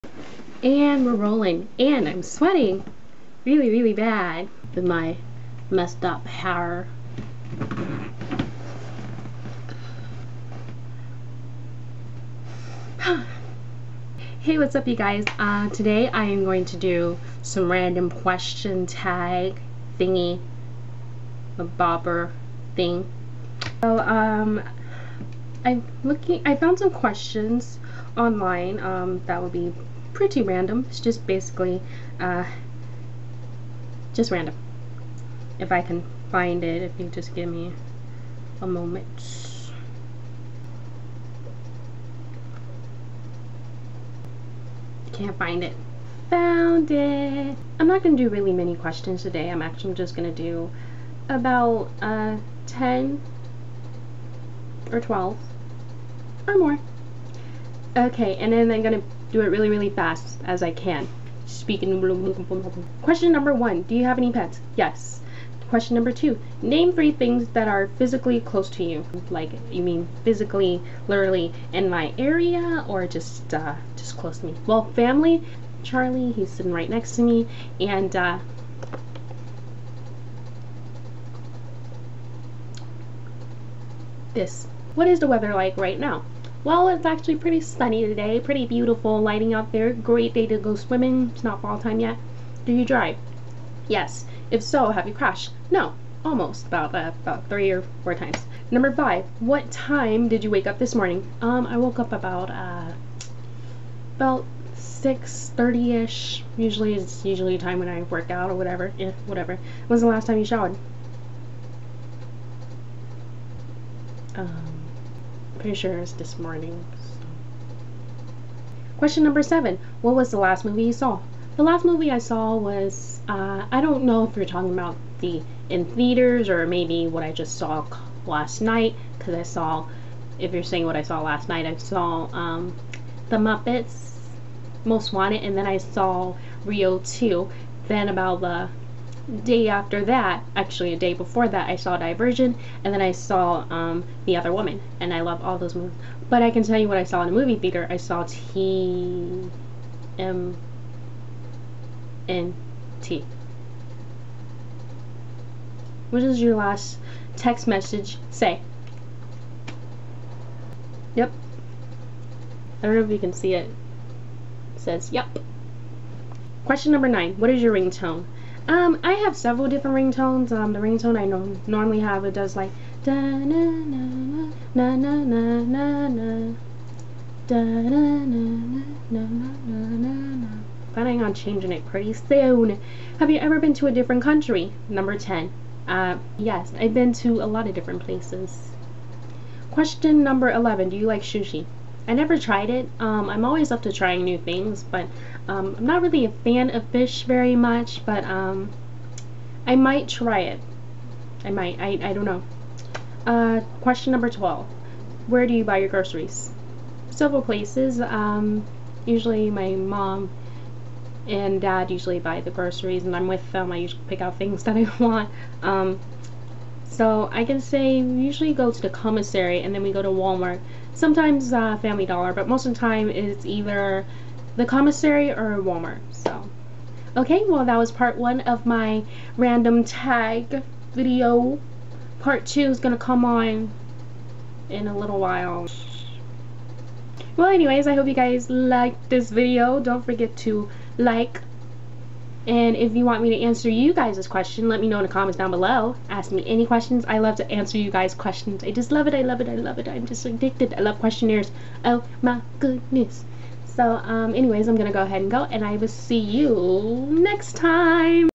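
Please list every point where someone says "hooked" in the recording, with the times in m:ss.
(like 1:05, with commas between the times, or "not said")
not said.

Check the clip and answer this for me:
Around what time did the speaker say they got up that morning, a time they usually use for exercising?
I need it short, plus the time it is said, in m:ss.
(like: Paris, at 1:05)
6:30, at 1:44.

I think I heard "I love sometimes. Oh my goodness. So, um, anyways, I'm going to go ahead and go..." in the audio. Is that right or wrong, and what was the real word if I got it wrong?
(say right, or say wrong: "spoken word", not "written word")
wrong: "questionnaires", not "sometimes".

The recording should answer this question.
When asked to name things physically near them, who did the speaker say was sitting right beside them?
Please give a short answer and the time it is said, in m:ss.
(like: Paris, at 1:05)
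Charlie, at 1:15.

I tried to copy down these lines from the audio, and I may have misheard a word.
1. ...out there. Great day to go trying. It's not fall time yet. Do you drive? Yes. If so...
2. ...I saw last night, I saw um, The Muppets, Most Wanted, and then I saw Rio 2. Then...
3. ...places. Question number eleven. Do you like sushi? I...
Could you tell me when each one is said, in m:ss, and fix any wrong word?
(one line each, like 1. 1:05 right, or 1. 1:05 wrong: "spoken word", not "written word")
1. 1:29 wrong: "swimming", not "trying"
2. 2:10 right
3. 3:08 right.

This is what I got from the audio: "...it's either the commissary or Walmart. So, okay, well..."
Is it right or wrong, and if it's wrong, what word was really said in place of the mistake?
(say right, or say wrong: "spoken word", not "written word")
right.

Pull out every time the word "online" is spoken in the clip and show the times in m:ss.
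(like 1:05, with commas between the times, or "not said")
0:28.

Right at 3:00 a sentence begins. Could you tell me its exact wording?
Planning on changing it pretty soon.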